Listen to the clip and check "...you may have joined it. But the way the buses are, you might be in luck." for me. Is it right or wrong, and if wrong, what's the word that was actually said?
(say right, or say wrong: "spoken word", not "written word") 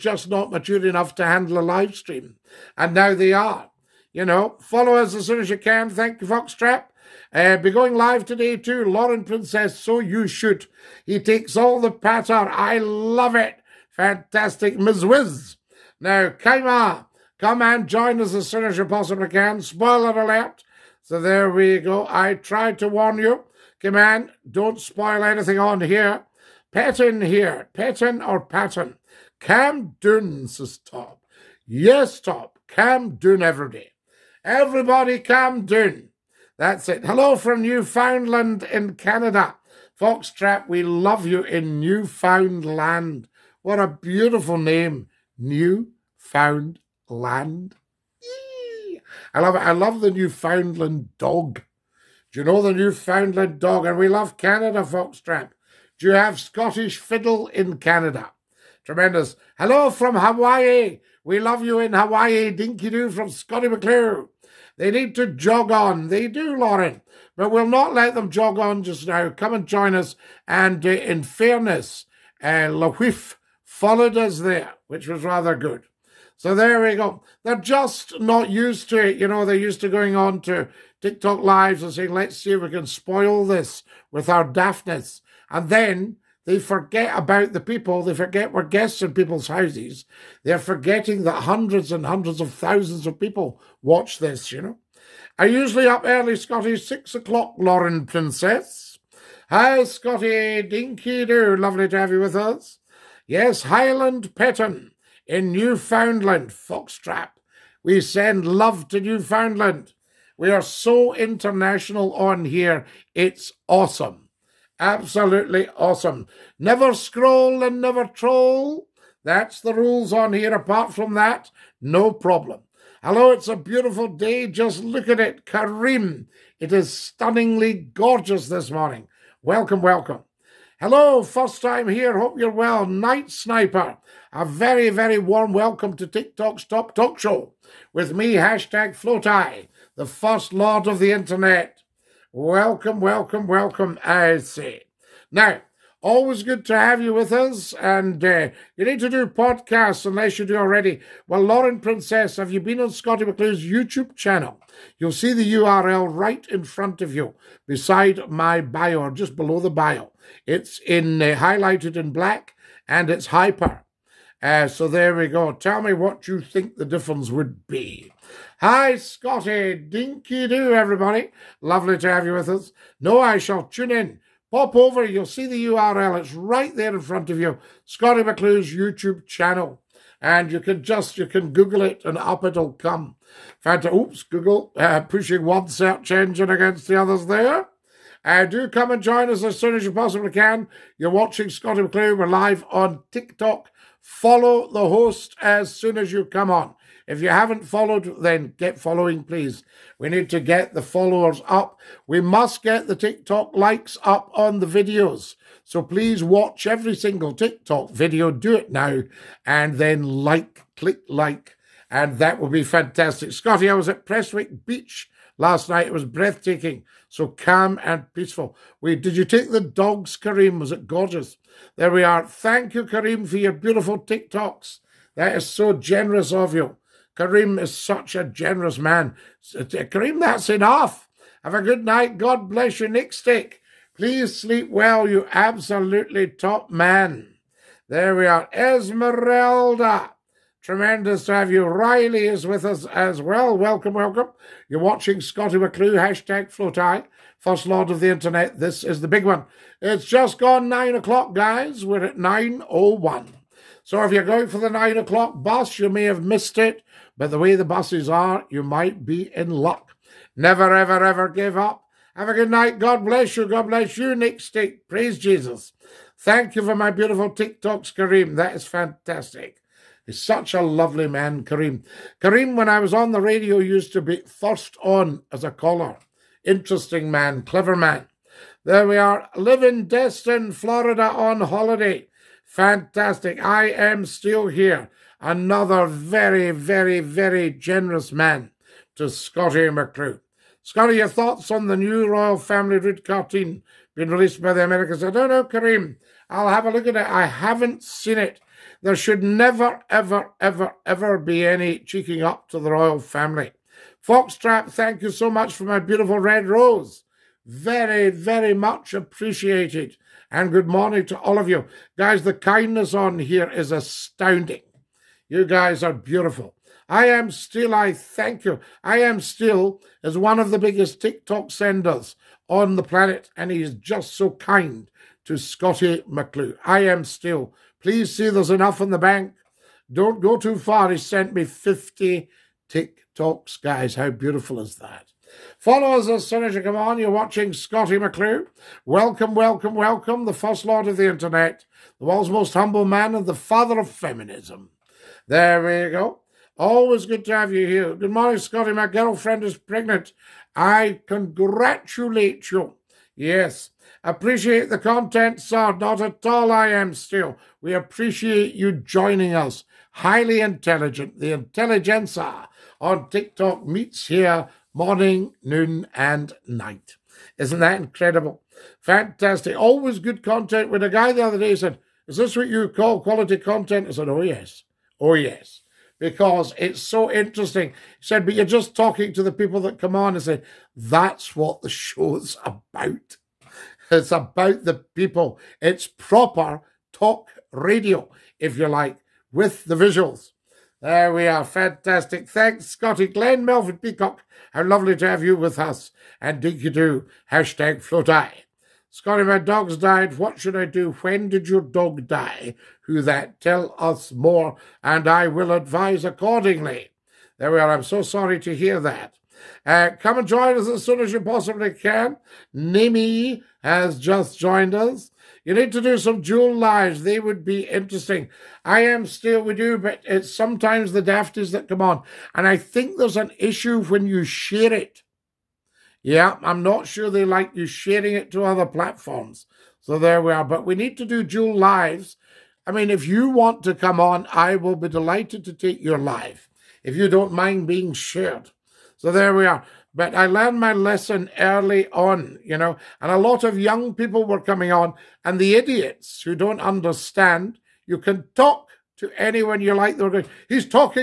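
wrong: "missed", not "joined".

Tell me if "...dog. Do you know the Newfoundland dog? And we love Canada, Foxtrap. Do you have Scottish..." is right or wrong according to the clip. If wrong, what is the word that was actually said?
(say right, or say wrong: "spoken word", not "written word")
right.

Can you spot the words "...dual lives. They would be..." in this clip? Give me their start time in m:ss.
6:56.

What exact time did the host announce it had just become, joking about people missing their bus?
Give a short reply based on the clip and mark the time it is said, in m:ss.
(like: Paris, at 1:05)
9.01, at 4:11.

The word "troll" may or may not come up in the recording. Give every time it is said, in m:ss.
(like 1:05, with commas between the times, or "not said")
1:58.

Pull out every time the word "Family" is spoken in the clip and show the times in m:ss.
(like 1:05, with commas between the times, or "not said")
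4:52, 5:02.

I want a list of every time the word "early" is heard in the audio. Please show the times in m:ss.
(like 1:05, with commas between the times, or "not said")
1:36, 7:21.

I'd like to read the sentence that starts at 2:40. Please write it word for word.
It's in uh, highlighted in black, and it's hyper.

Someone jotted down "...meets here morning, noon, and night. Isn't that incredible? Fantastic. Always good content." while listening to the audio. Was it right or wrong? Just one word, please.
right.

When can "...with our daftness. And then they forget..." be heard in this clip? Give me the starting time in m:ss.
1:24.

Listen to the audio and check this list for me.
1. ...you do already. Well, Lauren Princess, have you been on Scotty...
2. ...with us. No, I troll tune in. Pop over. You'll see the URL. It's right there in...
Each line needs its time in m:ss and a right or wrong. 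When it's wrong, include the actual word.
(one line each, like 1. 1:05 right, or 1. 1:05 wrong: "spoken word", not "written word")
1. 2:30 right
2. 2:52 wrong: "shall", not "troll".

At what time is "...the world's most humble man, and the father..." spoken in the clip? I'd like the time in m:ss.
5:42.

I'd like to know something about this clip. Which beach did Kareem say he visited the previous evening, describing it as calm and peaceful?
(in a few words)
Prestwick Beach.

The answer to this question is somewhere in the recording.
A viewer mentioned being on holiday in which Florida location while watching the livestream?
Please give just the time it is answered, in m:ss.
4:39.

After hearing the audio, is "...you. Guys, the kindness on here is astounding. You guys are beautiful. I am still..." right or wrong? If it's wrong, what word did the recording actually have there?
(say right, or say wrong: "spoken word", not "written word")
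right.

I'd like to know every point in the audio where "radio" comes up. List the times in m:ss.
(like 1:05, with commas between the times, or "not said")
4:33, 6:27.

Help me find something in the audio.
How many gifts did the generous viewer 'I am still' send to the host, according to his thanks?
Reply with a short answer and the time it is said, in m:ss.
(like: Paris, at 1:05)
50, at 5:31.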